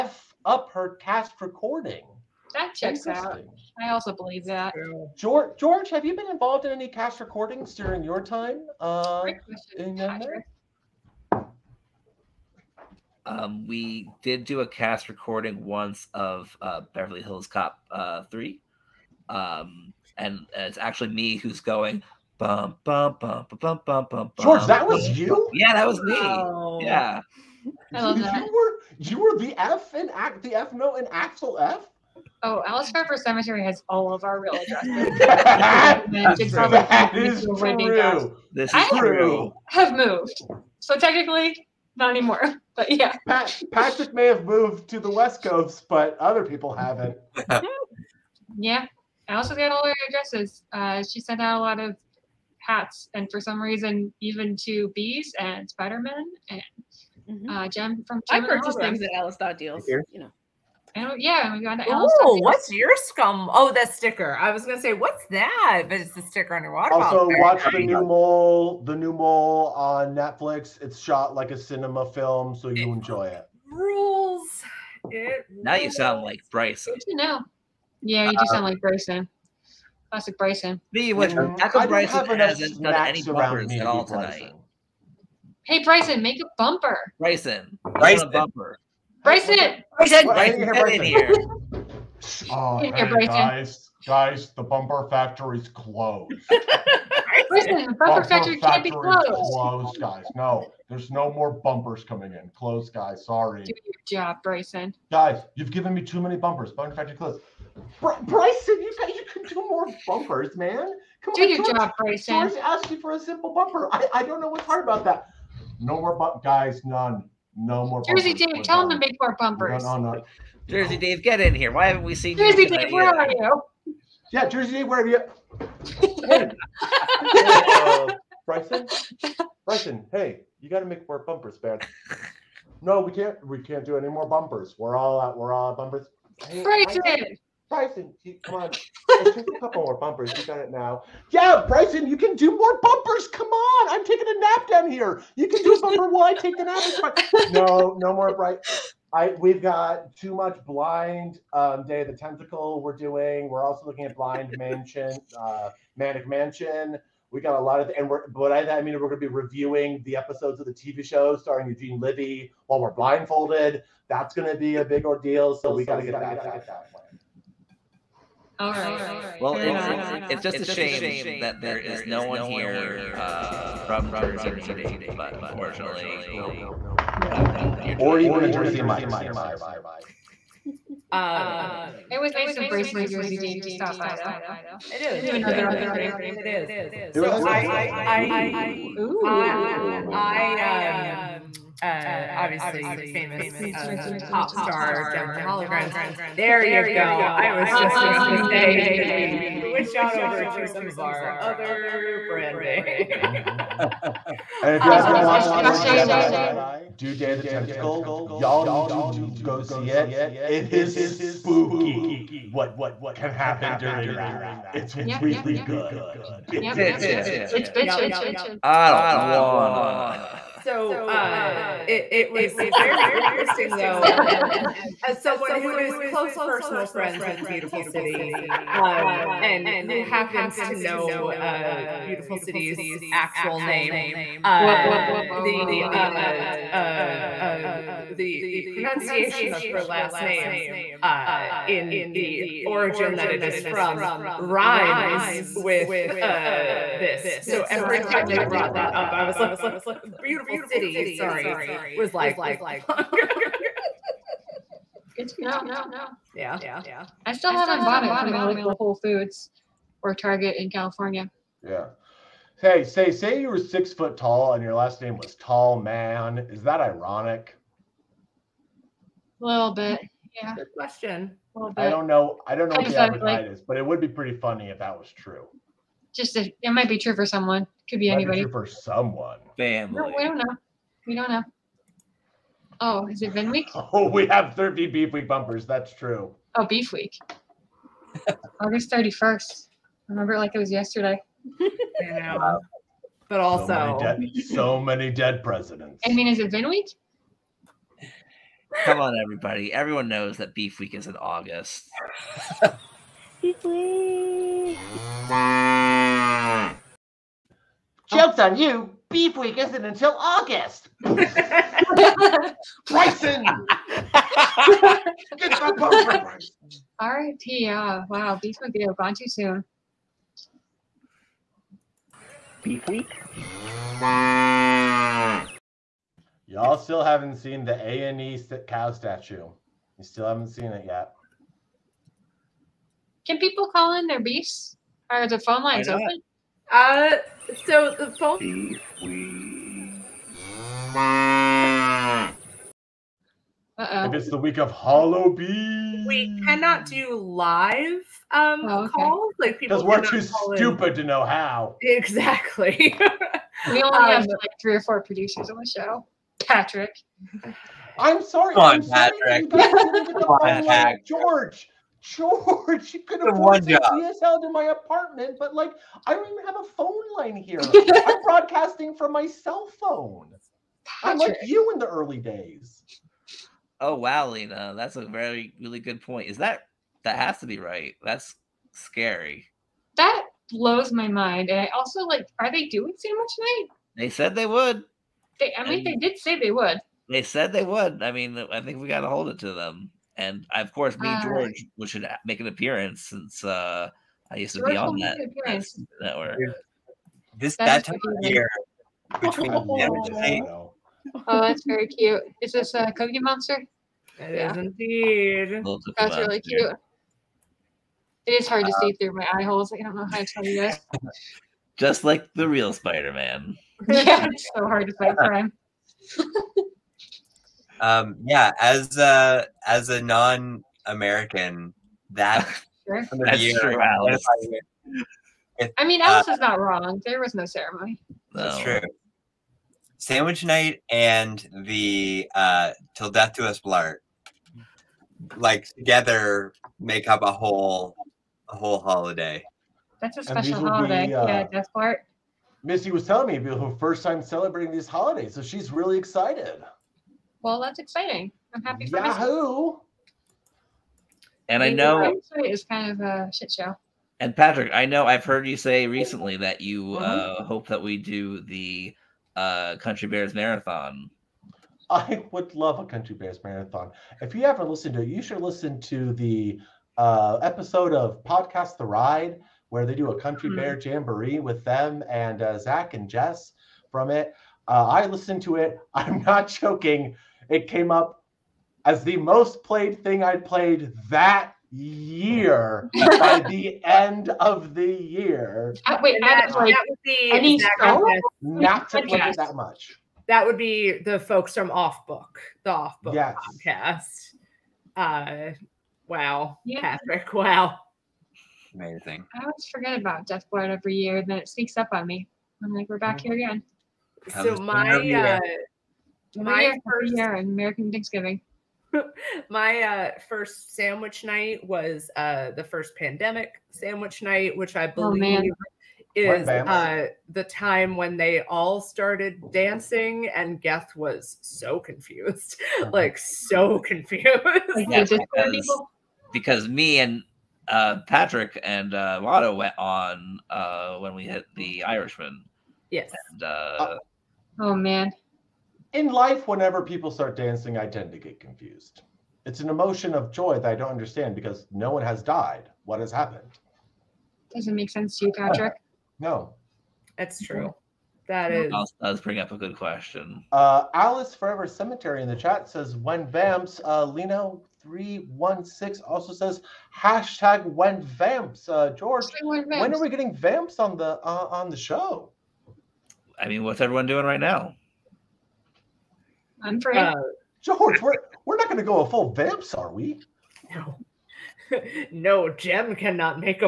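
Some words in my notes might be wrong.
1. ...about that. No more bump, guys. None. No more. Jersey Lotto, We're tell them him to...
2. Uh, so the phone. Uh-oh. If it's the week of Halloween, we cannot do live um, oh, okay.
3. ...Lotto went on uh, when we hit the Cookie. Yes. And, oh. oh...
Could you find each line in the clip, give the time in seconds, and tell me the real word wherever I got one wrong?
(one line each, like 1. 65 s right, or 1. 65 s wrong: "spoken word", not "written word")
1. 114 s wrong: "Dave", not "Lotto"
2. 336 s right
3. 529 s wrong: "Irishman", not "Cookie".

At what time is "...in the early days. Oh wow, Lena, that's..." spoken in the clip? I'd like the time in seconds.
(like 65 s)
371 s.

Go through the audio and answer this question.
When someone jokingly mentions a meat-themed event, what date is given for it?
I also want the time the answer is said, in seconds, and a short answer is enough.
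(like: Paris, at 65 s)
August 31st, at 288 s.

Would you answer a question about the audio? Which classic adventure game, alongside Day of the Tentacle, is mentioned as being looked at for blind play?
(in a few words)
Maniac Mansion.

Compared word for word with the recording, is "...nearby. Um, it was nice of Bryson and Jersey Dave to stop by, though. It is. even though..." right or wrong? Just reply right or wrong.
right.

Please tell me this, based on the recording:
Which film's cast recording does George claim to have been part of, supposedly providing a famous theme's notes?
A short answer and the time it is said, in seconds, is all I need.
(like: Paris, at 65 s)
Beverly Hills Cop 3, at 16 s.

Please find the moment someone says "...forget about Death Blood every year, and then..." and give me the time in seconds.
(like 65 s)
499 s.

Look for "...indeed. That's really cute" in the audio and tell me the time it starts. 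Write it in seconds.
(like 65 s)
404 s.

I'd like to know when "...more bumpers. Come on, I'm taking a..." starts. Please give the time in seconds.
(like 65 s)
142 s.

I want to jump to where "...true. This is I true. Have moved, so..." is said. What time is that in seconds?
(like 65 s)
37 s.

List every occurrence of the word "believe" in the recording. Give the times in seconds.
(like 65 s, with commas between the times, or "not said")
4 s, 515 s.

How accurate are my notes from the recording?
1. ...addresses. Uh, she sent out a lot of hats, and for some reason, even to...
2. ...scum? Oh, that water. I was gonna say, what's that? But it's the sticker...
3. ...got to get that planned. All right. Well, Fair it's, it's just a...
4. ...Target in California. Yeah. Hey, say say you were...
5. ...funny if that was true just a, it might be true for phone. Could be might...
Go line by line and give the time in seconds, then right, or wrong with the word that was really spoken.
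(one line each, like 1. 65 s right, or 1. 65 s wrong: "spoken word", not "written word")
1. 50 s right
2. 62 s wrong: "sticker", not "water"
3. 165 s right
4. 260 s right
5. 274 s wrong: "someone", not "phone".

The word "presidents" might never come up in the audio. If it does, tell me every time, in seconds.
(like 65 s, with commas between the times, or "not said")
295 s.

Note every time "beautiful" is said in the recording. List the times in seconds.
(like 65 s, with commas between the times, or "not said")
227 s, 232 s, 250 s.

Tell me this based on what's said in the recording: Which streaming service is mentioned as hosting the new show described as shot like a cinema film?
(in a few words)
Netflix.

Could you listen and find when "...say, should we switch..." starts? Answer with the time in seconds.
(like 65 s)
198 s.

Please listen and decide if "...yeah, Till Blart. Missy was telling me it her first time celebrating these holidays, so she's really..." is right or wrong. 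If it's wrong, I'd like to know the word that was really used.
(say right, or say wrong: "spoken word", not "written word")
wrong: "Death", not "Till".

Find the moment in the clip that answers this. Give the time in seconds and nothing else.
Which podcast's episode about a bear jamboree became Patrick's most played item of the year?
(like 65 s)
468 s.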